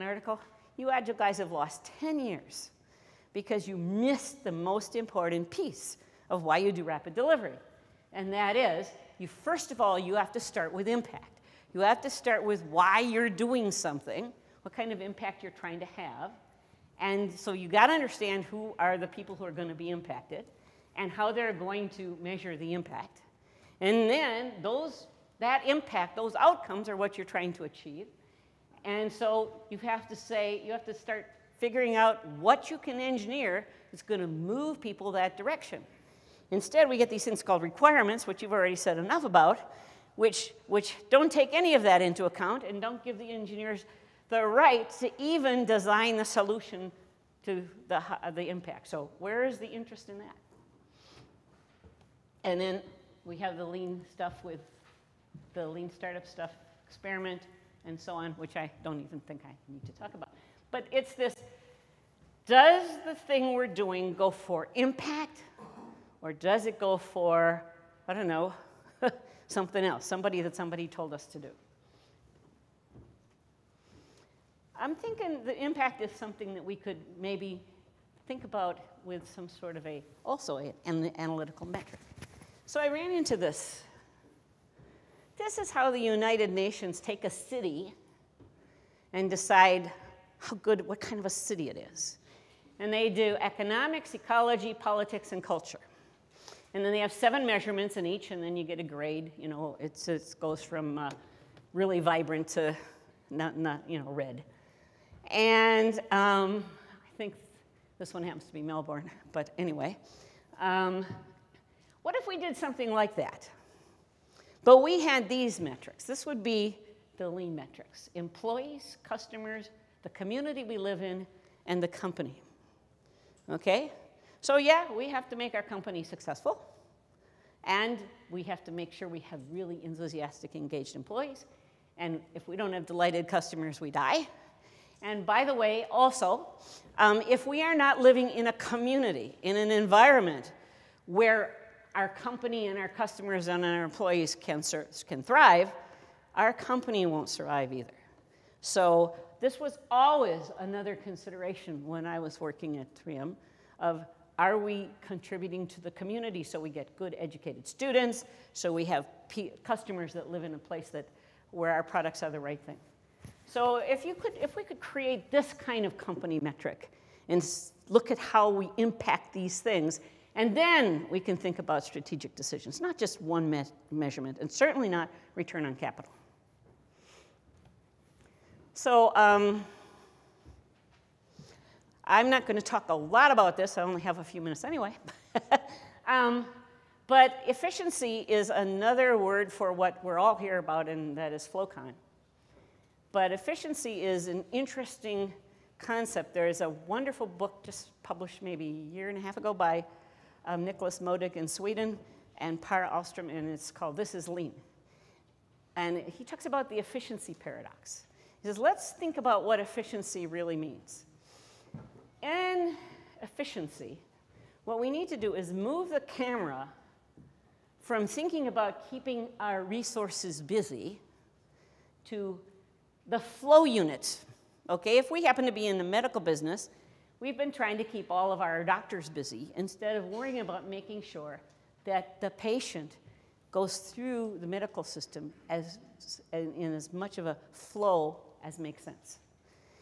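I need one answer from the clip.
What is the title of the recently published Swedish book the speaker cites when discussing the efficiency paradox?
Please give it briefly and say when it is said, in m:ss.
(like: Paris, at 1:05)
This is Lean, at 3:23.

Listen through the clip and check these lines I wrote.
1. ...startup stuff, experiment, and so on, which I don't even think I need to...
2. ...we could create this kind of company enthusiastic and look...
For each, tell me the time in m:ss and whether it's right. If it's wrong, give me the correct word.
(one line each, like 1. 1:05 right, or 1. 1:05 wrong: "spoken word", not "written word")
1. 0:55 right
2. 2:44 wrong: "metric", not "enthusiastic".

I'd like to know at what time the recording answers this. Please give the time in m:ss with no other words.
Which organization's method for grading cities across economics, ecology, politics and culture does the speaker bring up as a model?
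1:25.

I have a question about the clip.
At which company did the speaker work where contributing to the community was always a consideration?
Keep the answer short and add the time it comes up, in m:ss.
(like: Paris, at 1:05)
3M, at 2:33.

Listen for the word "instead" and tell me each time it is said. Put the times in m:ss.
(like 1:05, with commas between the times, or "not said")
0:36, 3:49.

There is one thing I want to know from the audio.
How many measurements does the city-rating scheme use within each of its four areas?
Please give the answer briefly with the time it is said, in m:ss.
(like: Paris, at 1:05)
7, at 1:37.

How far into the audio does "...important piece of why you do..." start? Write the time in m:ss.
0:04.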